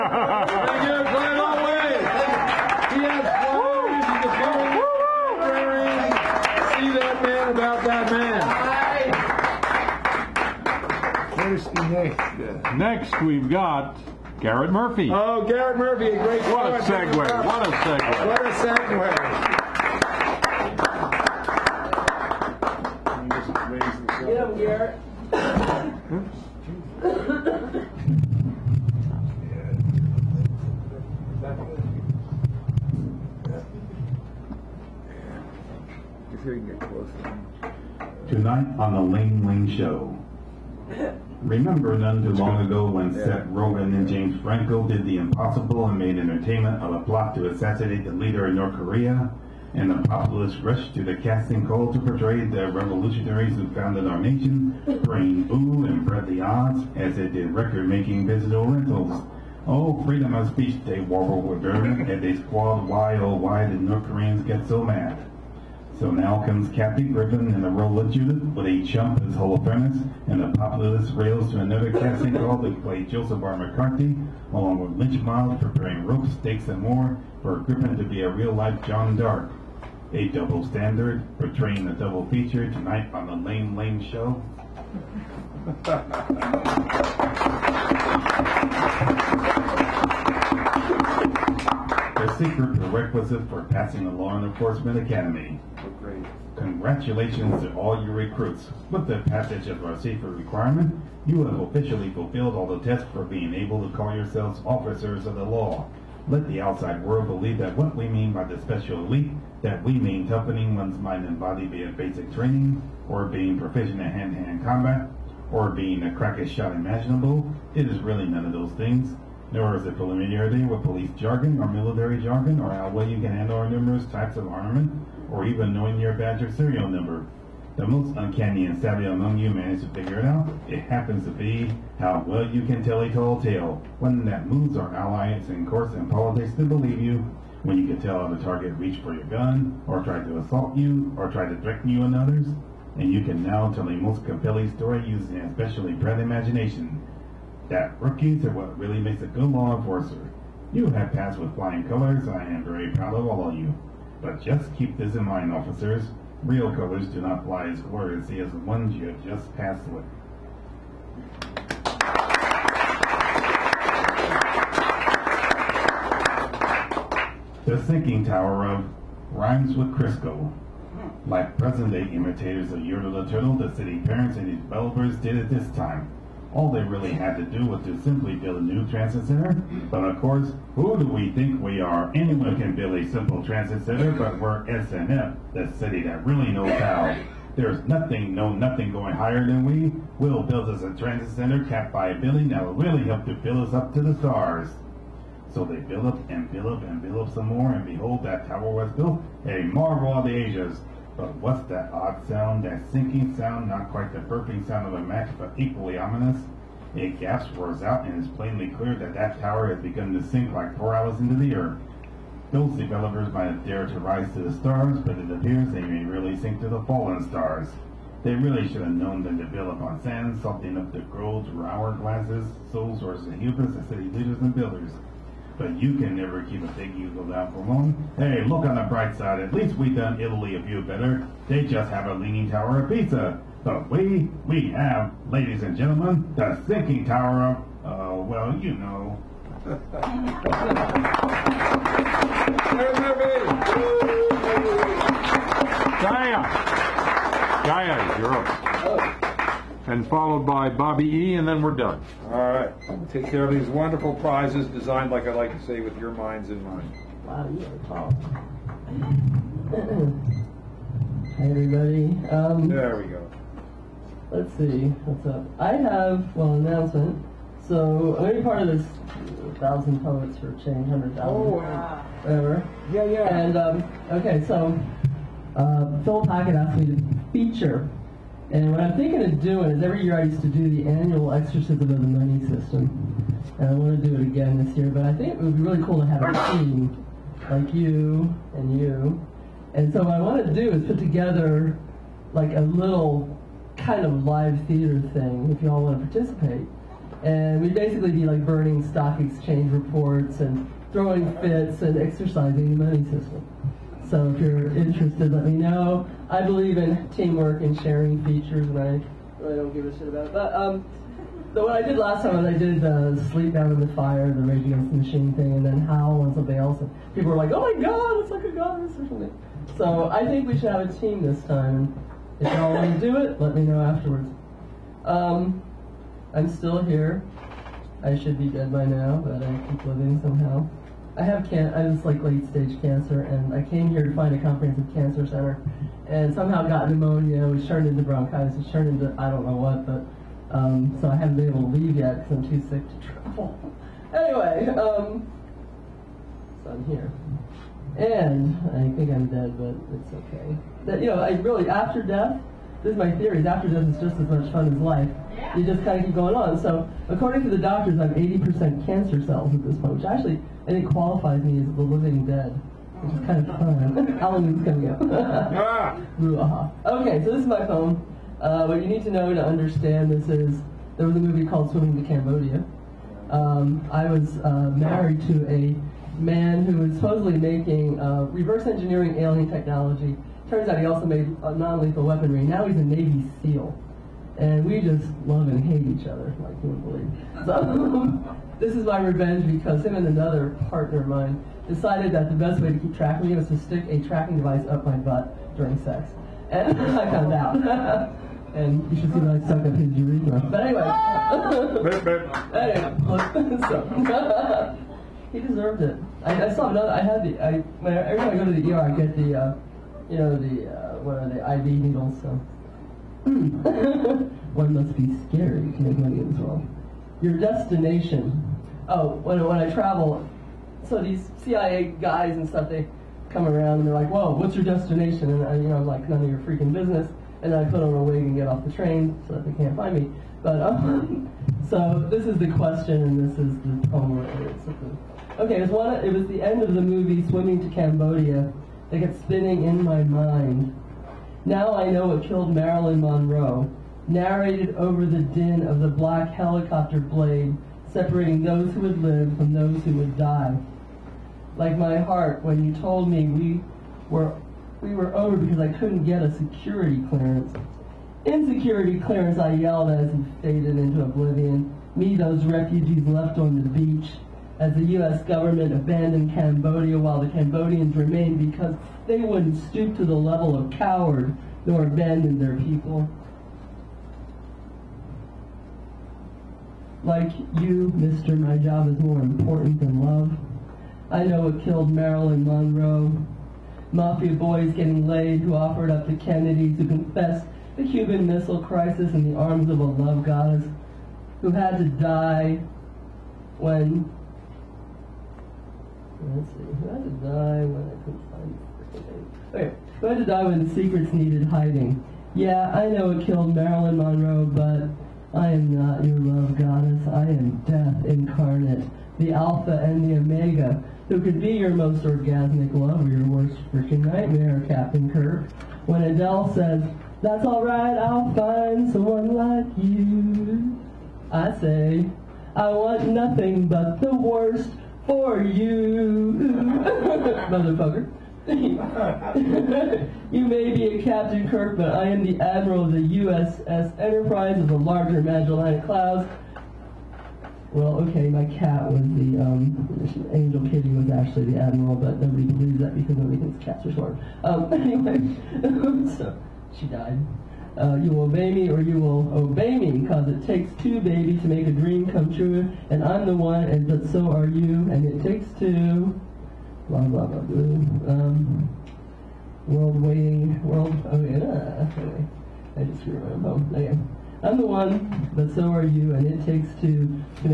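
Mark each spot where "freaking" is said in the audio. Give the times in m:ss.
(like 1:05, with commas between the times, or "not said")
7:06, 8:33.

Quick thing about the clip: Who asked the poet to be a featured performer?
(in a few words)
Phil Pocket.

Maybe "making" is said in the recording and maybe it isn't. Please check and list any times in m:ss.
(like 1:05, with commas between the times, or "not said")
0:57, 6:17.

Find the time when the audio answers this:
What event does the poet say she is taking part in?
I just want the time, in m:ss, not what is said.
4:28.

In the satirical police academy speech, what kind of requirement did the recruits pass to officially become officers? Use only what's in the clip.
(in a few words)
safer requirement.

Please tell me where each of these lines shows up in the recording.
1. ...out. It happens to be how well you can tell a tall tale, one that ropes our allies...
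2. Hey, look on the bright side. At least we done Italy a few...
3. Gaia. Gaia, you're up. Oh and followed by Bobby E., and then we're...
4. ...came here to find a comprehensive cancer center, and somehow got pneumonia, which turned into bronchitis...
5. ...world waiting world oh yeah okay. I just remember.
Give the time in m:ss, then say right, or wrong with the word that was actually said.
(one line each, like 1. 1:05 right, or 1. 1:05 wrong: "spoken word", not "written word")
1. 2:10 wrong: "moves", not "ropes"
2. 3:48 right
3. 4:06 right
4. 5:33 right
5. 9:19 right.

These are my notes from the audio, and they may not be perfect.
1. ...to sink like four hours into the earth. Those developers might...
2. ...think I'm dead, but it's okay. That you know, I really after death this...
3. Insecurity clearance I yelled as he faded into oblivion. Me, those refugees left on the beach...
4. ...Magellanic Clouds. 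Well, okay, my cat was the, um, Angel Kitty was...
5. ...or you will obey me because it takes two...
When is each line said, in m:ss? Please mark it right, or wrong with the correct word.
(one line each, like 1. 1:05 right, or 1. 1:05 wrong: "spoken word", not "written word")
1. 3:30 right
2. 5:48 right
3. 7:38 right
4. 8:55 right
5. 9:08 right.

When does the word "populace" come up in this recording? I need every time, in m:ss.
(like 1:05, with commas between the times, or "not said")
0:50, 1:10.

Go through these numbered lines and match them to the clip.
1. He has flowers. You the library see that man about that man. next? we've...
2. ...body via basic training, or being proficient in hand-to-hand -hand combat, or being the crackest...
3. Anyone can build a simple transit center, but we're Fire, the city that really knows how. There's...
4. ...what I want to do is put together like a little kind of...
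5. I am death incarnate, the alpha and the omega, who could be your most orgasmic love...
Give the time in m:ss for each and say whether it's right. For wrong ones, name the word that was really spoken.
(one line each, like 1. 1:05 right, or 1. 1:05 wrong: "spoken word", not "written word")
1. 0:02 right
2. 1:51 right
3. 3:02 wrong: "SNF", not "Fire"
4. 4:50 right
5. 8:27 right.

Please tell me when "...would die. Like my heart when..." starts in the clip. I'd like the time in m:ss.
7:29.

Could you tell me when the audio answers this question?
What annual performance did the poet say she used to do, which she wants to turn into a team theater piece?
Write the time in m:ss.
4:41.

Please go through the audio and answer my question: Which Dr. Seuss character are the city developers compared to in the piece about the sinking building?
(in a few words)
Yertle the Turtle.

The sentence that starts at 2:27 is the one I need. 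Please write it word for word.
That rookies are what really makes a good law enforcer.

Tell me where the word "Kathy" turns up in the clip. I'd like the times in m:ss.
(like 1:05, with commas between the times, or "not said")
1:06.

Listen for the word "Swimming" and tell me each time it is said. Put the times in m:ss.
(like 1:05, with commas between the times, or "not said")
6:11, 7:17.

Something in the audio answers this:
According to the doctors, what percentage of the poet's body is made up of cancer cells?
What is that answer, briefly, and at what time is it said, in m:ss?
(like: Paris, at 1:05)
80%, at 5:58.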